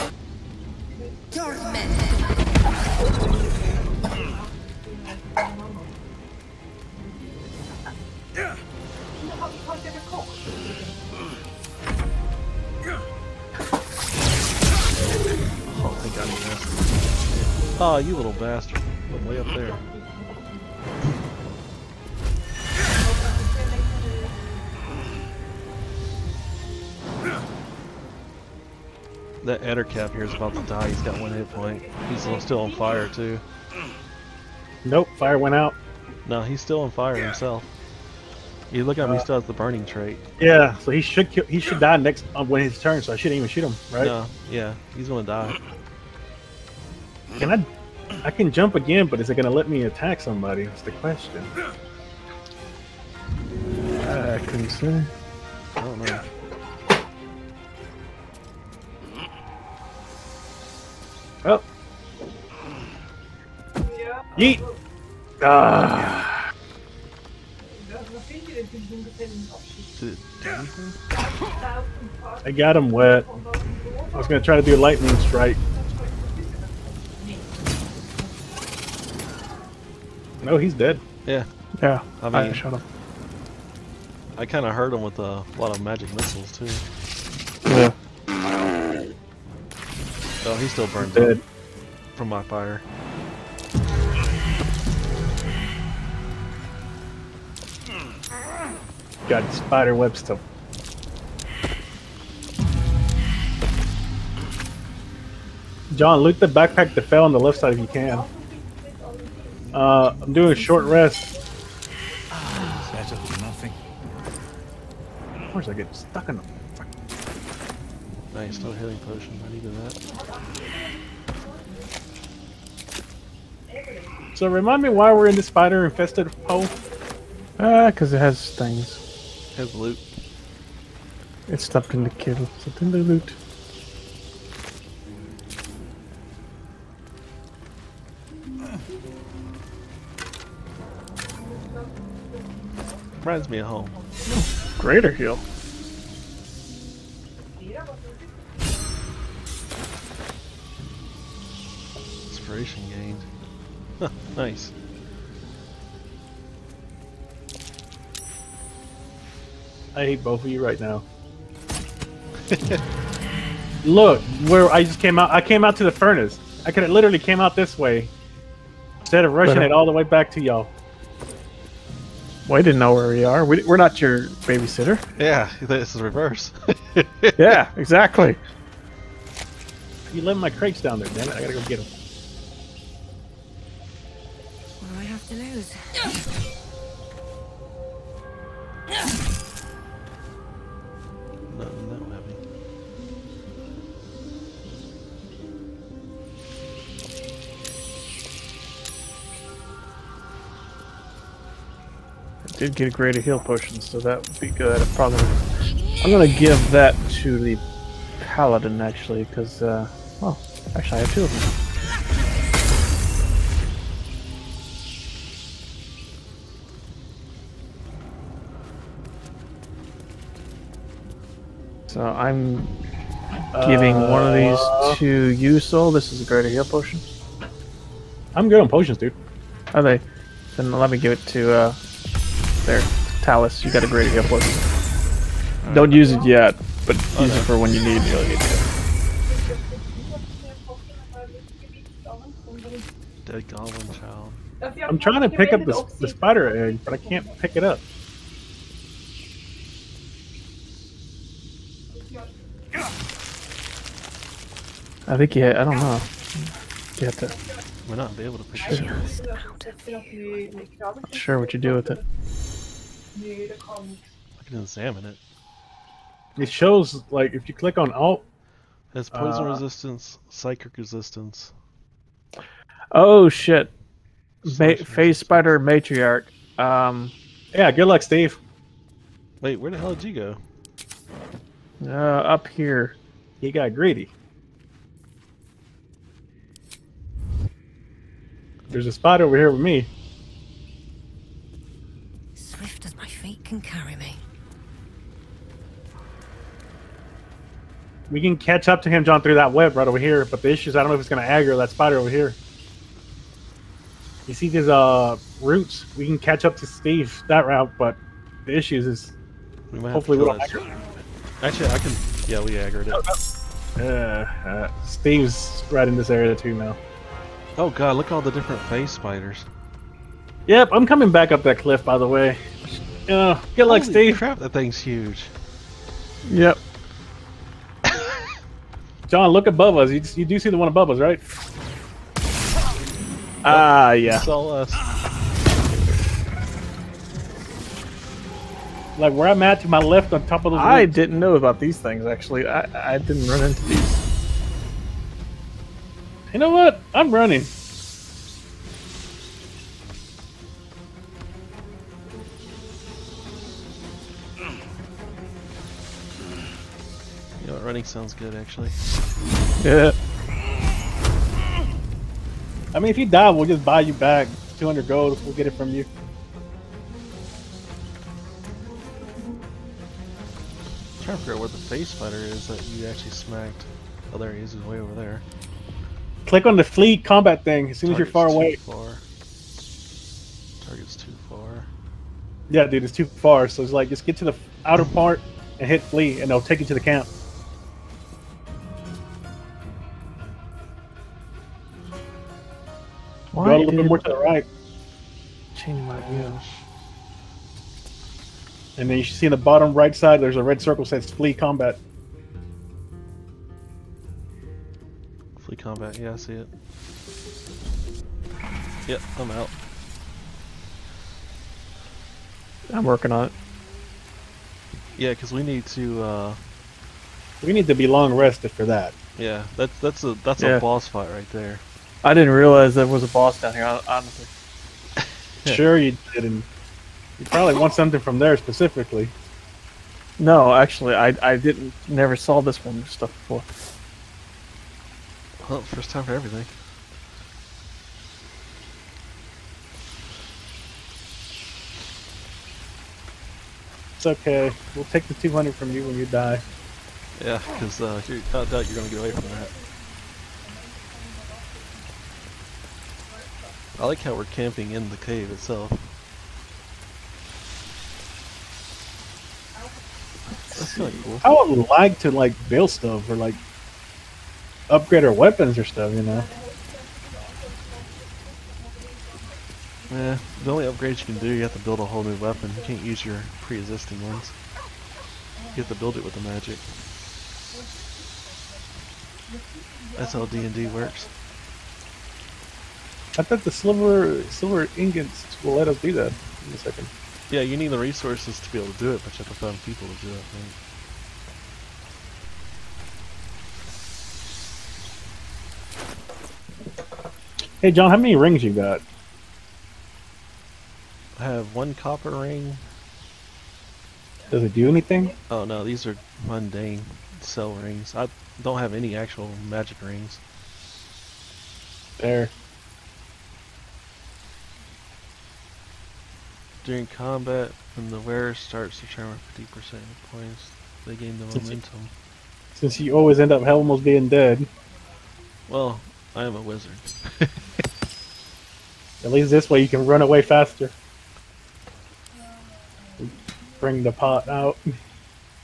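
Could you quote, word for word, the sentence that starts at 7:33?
I like how we're camping in the cave itself.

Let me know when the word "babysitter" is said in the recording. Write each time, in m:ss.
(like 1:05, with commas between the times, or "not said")
2:54.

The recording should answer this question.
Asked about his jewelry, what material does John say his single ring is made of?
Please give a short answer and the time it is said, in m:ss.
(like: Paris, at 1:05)
Copper, at 8:21.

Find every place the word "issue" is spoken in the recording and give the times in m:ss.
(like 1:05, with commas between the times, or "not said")
5:00, 5:08.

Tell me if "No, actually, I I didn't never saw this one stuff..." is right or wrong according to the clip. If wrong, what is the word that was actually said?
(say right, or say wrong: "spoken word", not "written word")
right.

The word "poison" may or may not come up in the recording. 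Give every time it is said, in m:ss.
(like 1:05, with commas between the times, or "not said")
4:29.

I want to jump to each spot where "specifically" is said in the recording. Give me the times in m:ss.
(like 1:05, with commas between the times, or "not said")
7:08.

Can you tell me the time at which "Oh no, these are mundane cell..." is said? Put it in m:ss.
8:25.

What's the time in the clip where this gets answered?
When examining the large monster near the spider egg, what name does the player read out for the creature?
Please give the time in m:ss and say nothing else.
4:35.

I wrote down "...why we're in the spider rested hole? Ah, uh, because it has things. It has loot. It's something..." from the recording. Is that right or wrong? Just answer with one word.
wrong.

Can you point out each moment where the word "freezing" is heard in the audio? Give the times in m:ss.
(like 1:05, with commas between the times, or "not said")
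not said.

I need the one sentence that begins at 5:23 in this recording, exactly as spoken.
You uh, know, get like Holy Steve.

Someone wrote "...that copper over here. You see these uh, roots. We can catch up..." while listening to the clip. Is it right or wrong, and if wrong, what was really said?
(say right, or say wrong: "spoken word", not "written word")
wrong: "spider", not "copper".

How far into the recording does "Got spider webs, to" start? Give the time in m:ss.
1:39.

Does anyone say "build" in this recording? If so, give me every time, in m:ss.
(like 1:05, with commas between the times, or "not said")
7:42, 7:51, 7:55.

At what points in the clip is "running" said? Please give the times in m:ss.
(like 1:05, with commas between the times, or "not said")
5:47, 5:57.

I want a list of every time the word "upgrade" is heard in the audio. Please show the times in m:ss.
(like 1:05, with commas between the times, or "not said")
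7:44, 7:50.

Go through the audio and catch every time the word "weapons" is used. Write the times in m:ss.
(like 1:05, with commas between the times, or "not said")
7:45, 7:52.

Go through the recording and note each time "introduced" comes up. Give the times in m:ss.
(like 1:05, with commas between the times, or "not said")
not said.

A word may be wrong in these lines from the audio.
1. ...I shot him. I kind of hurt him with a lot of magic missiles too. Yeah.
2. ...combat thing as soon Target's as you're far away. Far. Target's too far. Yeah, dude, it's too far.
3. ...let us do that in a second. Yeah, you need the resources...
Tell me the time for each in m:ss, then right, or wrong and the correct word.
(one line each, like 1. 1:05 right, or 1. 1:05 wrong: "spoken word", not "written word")
1. 1:22 right
2. 6:16 right
3. 8:05 right.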